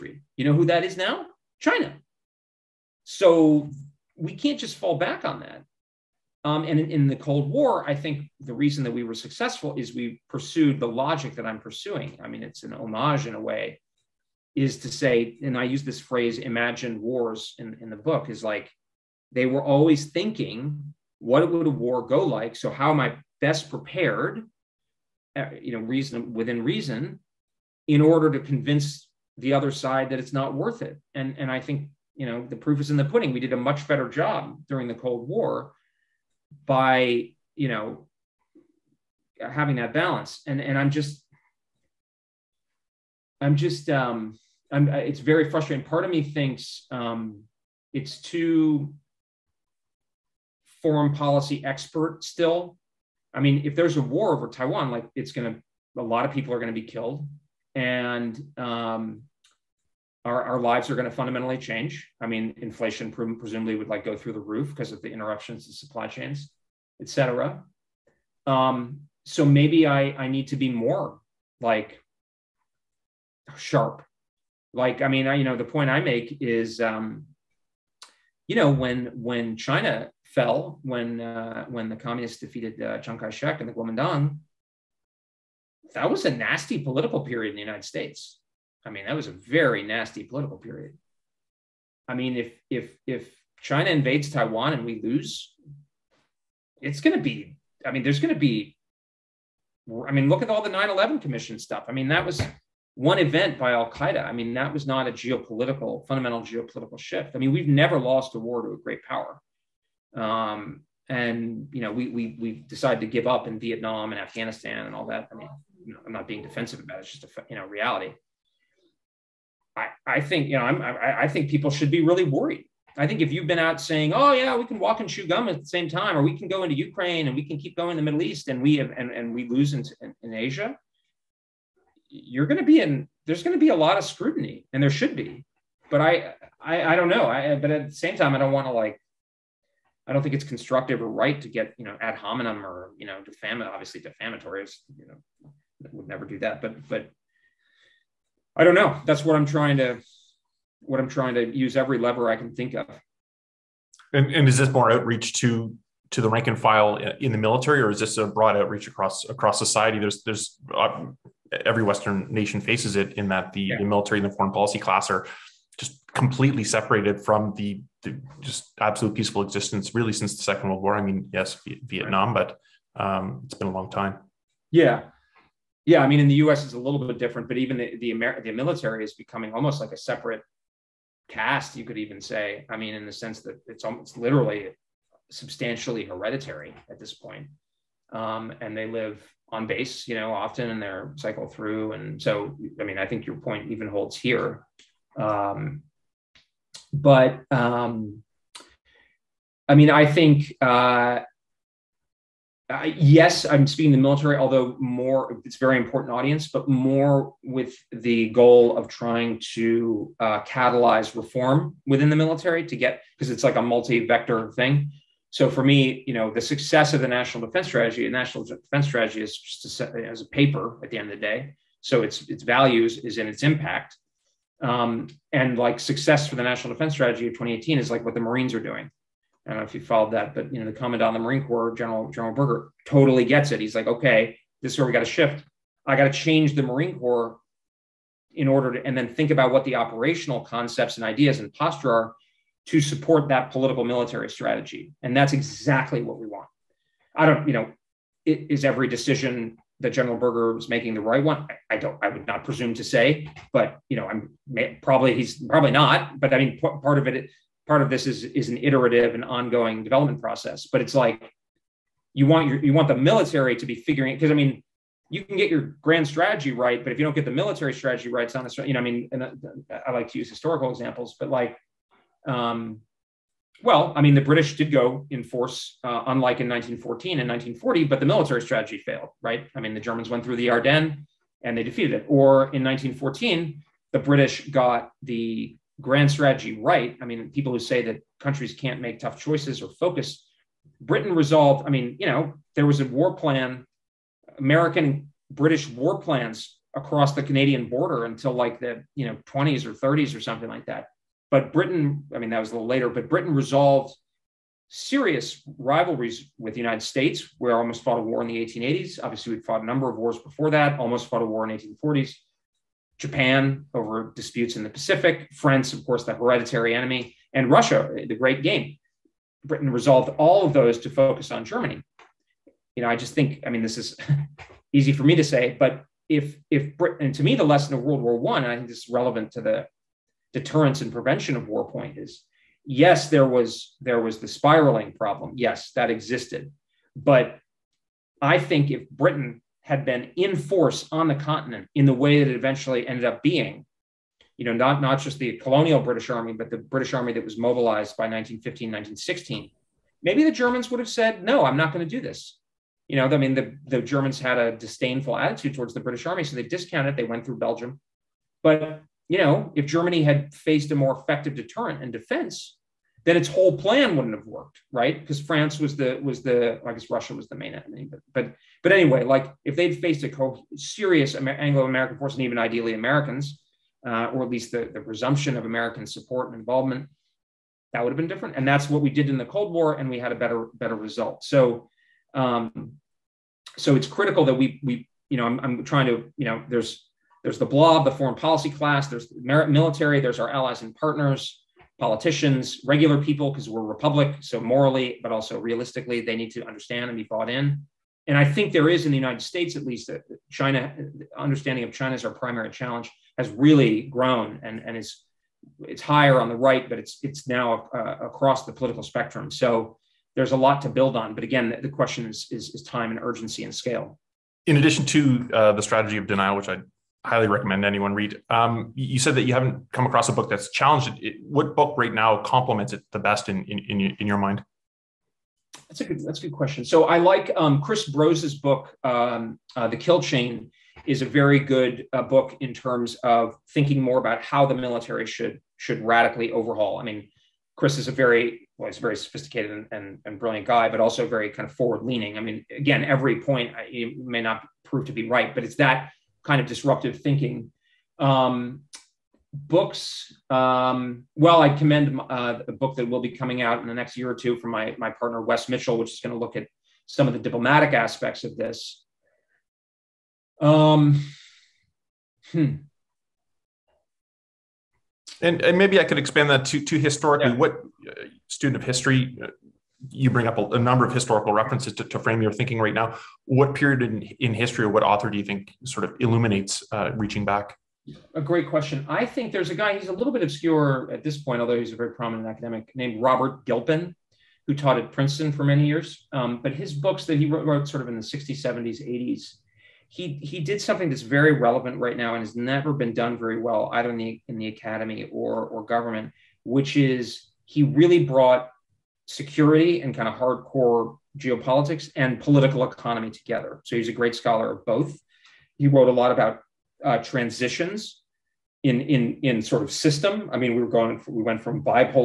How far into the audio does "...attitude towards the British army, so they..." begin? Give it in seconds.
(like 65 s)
355 s.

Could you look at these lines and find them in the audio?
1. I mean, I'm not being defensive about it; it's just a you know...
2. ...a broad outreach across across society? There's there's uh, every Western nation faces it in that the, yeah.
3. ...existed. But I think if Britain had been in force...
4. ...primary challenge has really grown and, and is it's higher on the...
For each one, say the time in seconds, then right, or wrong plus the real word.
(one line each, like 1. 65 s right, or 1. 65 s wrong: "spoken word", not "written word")
1. 115 s right
2. 158 s right
3. 335 s right
4. 402 s right.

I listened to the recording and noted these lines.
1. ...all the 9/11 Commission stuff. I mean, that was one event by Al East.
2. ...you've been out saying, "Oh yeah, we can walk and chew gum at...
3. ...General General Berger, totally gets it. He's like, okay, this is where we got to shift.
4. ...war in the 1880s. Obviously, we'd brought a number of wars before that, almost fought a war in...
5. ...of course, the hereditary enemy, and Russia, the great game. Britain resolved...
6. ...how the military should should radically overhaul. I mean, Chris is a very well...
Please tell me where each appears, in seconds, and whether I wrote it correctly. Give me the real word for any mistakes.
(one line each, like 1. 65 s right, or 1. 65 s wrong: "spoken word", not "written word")
1. 100 s wrong: "Qaeda", not "East"
2. 123 s right
3. 231 s right
4. 308 s wrong: "fought", not "brought"
5. 315 s right
6. 434 s right.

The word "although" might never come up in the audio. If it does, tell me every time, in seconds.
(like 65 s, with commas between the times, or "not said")
204 s, 481 s.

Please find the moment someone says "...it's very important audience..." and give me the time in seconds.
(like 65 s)
205 s.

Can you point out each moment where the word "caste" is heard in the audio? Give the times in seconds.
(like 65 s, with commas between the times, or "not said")
181 s.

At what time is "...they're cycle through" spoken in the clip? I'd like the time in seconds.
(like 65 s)
190 s.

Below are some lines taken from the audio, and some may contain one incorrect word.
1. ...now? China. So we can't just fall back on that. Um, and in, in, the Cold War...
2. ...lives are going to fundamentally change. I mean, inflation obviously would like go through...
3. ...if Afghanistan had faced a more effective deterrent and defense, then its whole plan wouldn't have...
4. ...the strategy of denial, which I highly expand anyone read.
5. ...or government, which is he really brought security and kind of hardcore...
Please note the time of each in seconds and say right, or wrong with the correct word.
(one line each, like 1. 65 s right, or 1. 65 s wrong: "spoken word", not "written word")
1. 0 s right
2. 60 s wrong: "presumably", not "obviously"
3. 359 s wrong: "Germany", not "Afghanistan"
4. 415 s wrong: "recommend", not "expand"
5. 495 s right.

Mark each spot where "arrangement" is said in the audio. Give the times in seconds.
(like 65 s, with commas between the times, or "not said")
not said.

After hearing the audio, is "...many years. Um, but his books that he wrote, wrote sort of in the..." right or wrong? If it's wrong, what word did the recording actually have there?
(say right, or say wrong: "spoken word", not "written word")
right.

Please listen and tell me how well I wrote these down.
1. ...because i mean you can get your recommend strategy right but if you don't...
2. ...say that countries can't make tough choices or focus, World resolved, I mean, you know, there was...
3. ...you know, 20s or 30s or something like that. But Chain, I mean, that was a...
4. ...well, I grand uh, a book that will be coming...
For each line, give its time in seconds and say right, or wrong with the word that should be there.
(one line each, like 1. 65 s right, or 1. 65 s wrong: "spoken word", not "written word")
1. 264 s wrong: "grand", not "recommend"
2. 287 s wrong: "Britain", not "World"
3. 298 s wrong: "Britain", not "Chain"
4. 451 s wrong: "commend", not "grand".